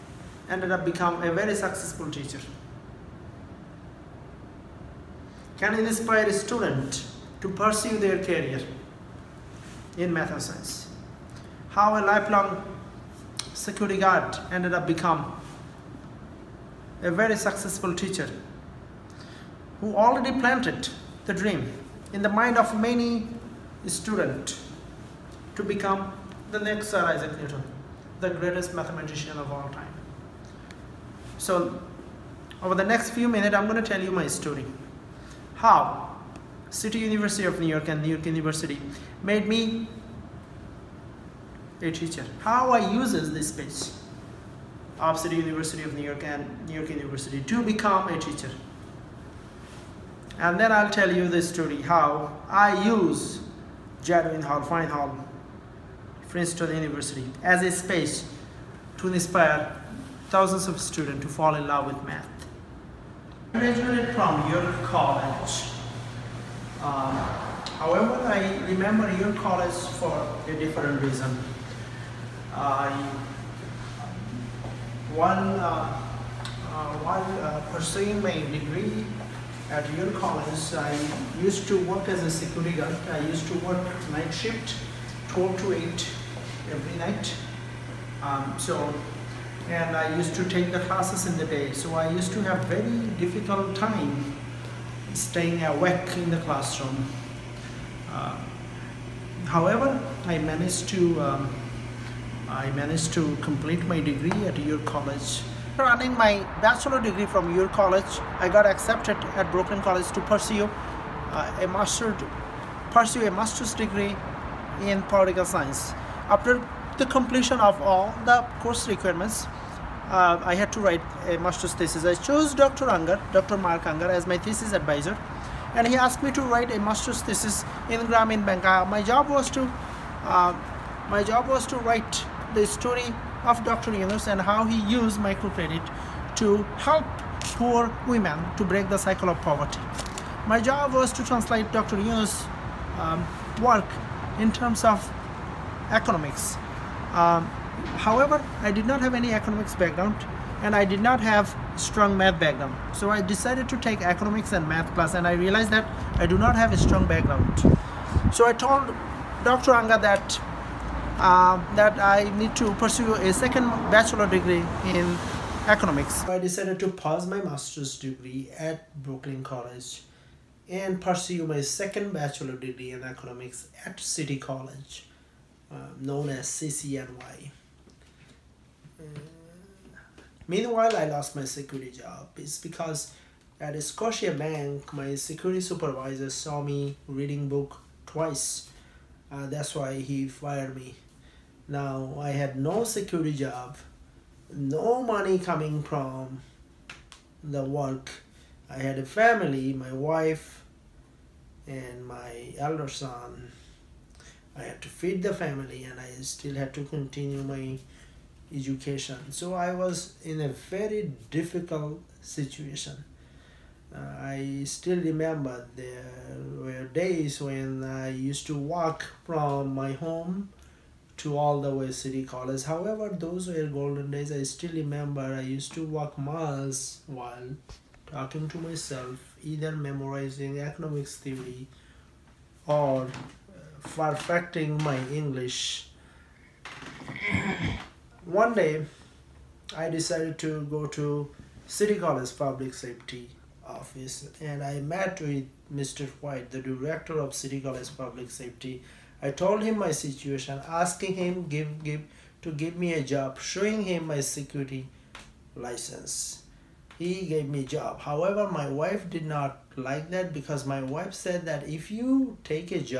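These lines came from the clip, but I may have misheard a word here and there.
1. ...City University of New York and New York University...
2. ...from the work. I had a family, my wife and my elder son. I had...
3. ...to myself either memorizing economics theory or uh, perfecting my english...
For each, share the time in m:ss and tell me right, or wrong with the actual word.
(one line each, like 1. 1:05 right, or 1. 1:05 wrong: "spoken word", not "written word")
1. 0:36 right
2. 3:15 right
3. 3:48 right.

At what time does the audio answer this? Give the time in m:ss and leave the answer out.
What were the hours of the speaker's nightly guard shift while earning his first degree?
1:25.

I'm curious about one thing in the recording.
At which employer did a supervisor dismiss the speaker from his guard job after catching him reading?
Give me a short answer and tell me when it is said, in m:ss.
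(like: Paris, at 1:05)
Scotia Bank, at 3:03.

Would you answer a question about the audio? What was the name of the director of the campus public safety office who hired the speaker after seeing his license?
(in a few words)
Mr. White.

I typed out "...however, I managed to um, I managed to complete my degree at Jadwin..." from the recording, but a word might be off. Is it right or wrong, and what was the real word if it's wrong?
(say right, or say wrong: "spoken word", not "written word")
wrong: "York", not "Jadwin".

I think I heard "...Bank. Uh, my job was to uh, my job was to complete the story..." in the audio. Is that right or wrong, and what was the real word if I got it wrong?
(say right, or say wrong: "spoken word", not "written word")
wrong: "write", not "complete".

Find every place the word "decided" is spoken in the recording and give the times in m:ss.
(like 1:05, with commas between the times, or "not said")
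2:33, 2:46, 3:59.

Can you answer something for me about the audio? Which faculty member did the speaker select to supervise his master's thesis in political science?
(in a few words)
Dr. Mark Anger.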